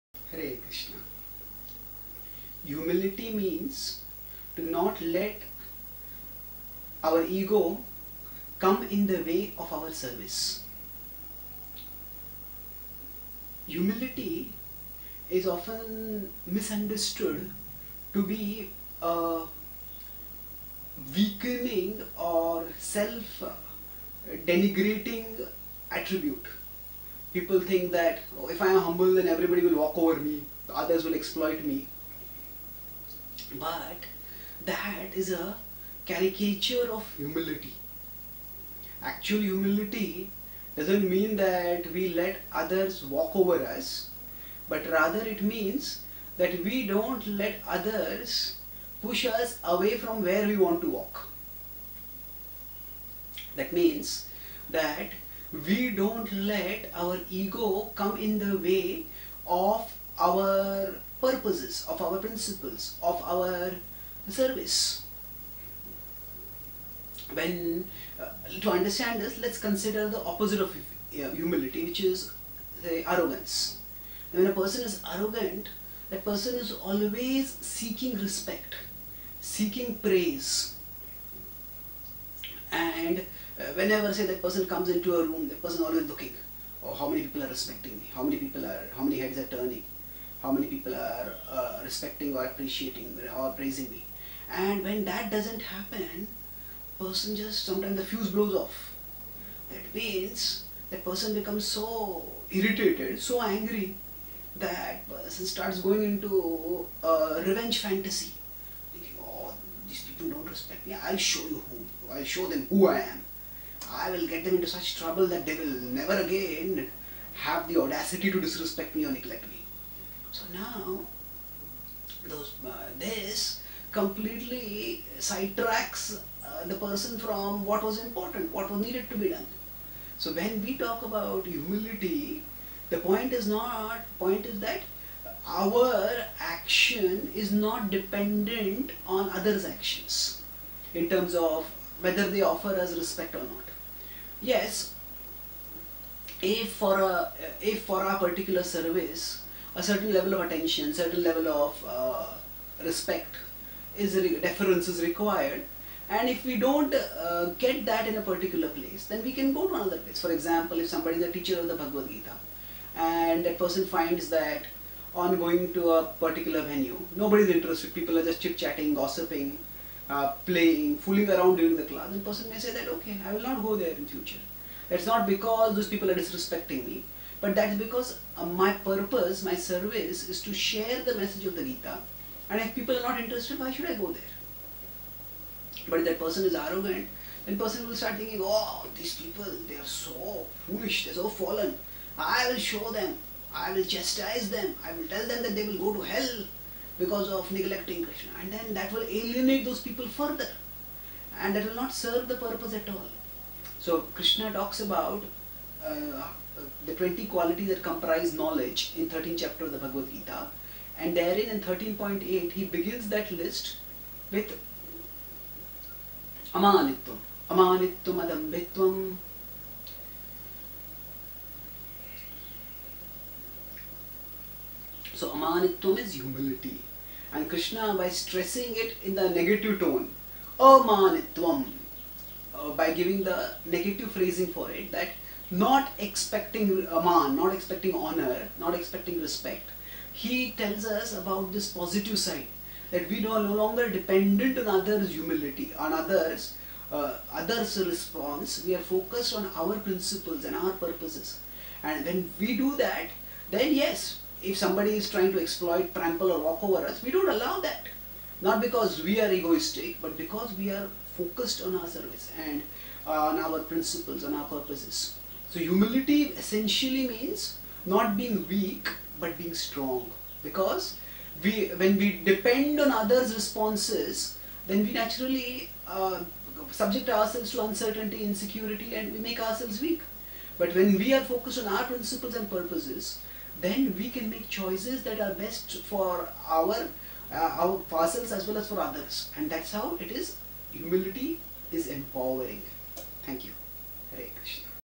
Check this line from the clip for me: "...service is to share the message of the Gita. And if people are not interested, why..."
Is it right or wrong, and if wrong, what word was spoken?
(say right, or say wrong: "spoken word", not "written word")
right.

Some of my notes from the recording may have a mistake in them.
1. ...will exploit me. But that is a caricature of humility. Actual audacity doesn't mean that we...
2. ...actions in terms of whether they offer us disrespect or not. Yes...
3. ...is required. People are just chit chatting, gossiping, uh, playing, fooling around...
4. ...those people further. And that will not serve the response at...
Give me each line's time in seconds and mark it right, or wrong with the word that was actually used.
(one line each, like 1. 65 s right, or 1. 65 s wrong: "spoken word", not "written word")
1. 31 s wrong: "humility", not "audacity"
2. 139 s wrong: "respect", not "disrespect"
3. 167 s wrong: "interested", not "required"
4. 199 s wrong: "purpose", not "response".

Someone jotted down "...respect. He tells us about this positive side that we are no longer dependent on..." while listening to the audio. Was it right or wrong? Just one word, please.
right.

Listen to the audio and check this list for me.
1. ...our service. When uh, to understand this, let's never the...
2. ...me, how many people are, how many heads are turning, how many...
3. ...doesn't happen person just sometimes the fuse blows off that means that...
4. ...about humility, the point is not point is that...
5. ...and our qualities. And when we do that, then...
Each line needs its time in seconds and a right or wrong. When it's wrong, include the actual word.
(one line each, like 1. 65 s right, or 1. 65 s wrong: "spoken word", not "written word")
1. 63 s wrong: "consider", not "never"
2. 87 s right
3. 95 s right
4. 131 s right
5. 250 s wrong: "purposes", not "qualities".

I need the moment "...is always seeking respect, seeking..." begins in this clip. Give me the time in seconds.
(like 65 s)
76 s.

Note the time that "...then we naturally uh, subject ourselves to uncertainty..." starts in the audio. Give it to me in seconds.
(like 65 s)
274 s.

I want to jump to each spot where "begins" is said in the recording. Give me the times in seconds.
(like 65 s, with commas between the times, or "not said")
212 s.